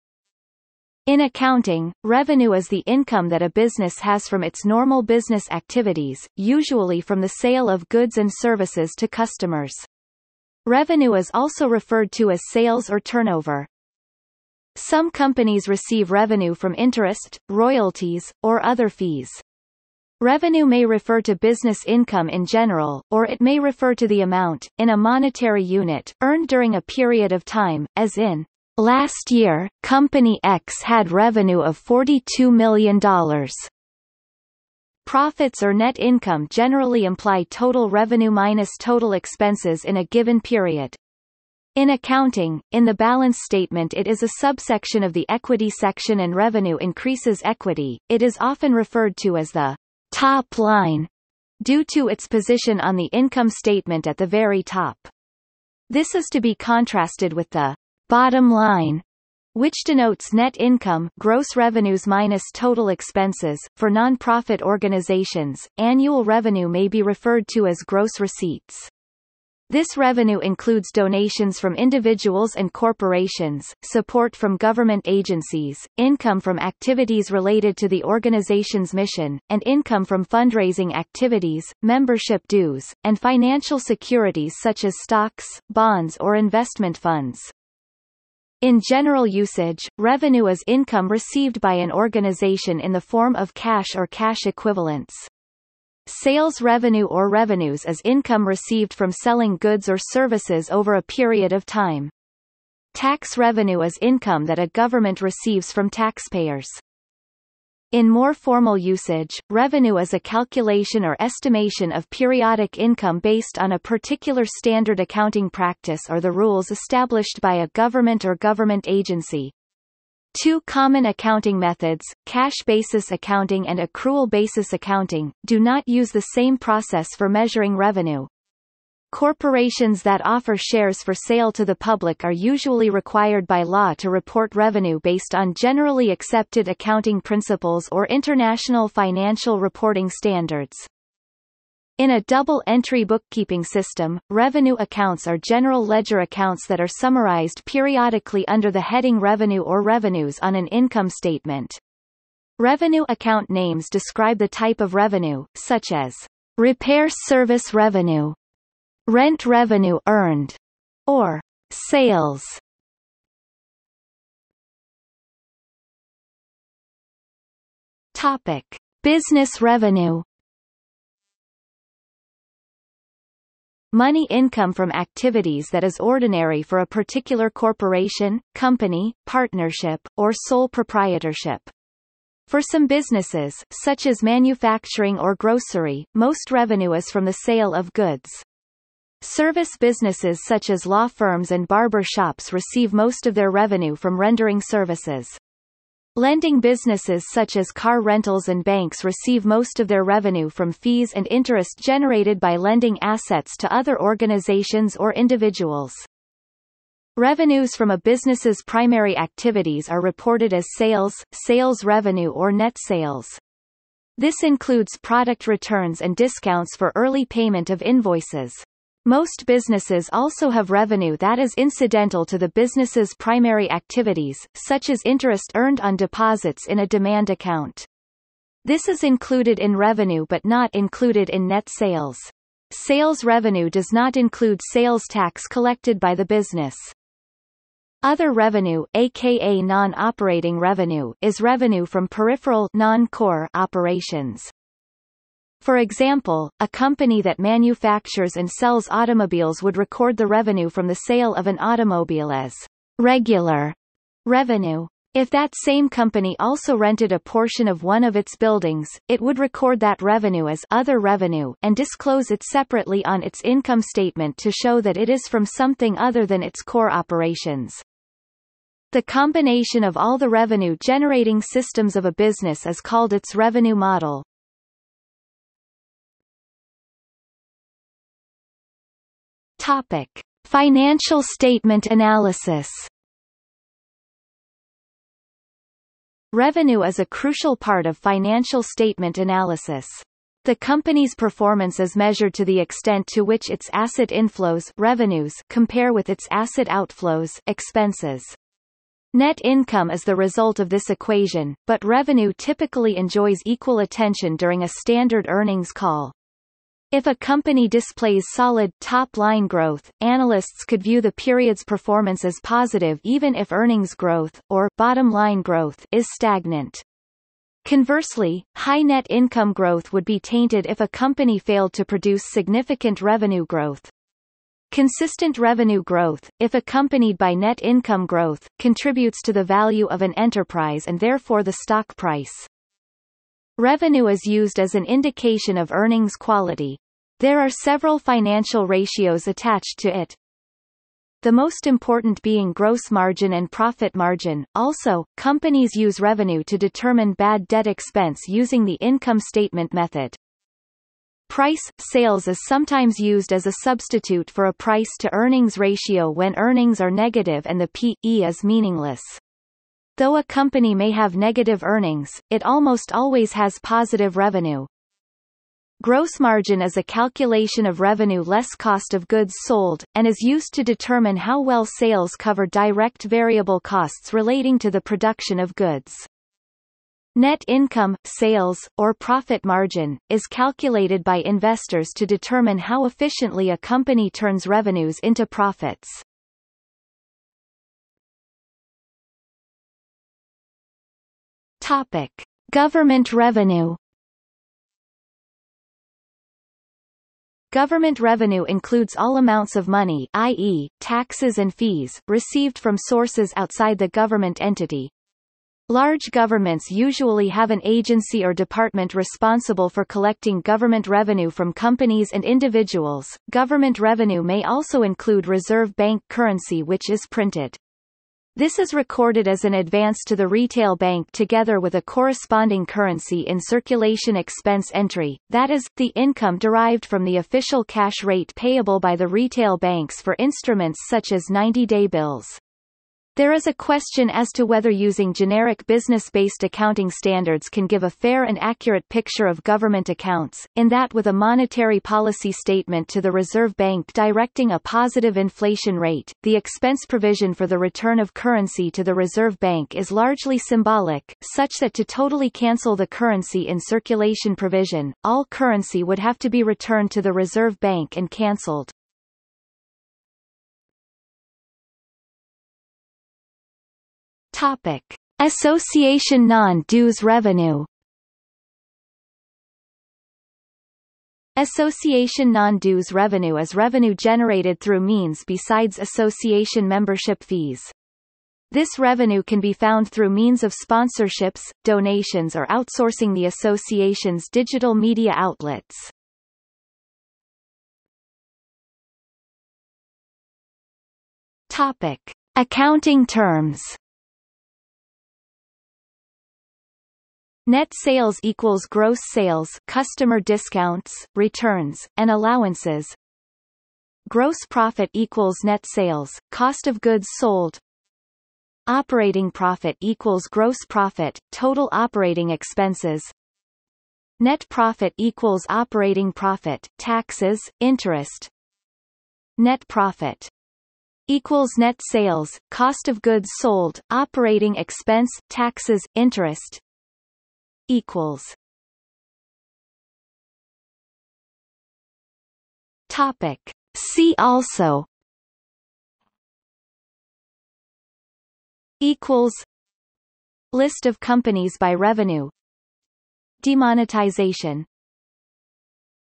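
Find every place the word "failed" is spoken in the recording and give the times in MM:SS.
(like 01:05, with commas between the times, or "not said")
05:21.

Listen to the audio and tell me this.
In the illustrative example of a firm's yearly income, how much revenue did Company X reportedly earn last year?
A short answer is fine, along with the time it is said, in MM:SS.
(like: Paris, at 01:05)
$42 million, at 00:31.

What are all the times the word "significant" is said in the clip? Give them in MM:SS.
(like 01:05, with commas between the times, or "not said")
05:22.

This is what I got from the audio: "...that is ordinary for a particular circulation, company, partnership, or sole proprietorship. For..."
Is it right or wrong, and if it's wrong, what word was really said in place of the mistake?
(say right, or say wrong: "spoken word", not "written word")
wrong: "corporation", not "circulation".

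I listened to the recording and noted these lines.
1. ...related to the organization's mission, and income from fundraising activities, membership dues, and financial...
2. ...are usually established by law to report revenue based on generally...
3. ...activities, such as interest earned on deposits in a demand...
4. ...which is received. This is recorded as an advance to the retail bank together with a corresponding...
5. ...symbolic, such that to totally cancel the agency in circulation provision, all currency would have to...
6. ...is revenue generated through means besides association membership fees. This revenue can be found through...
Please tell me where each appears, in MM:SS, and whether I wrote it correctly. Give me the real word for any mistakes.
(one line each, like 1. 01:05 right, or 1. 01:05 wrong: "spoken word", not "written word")
1. 01:17 right
2. 02:12 wrong: "required", not "established"
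3. 03:43 right
4. 06:56 wrong: "printed", not "received"
5. 07:30 wrong: "currency", not "agency"
6. 07:53 right.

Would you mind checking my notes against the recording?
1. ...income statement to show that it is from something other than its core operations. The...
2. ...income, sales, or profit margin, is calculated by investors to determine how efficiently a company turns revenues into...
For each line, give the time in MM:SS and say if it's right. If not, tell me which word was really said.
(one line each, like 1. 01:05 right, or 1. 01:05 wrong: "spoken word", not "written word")
1. 04:23 right
2. 06:17 right.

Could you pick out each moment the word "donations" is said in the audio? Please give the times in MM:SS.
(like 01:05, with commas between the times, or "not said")
01:10, 08:01.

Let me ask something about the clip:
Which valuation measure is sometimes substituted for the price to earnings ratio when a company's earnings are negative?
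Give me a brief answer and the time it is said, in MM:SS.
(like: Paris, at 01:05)
Price sales, at 05:51.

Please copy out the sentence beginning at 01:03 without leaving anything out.
For nonprofit organizations, annual revenue may be referred to as gross receipts.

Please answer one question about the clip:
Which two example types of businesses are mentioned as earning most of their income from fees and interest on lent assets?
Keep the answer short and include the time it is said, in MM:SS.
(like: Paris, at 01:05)
car rentals and banks, at 03:17.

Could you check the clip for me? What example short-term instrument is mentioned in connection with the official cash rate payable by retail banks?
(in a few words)
90-day bills.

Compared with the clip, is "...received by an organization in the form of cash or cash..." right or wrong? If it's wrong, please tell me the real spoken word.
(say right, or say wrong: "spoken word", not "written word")
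right.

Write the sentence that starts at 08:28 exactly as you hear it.
Operating profit equals gross profit, total operating expenses.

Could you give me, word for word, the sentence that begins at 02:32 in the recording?
Revenue account names describe the type of revenue, such as repair service revenue, rent revenue earned, or sales.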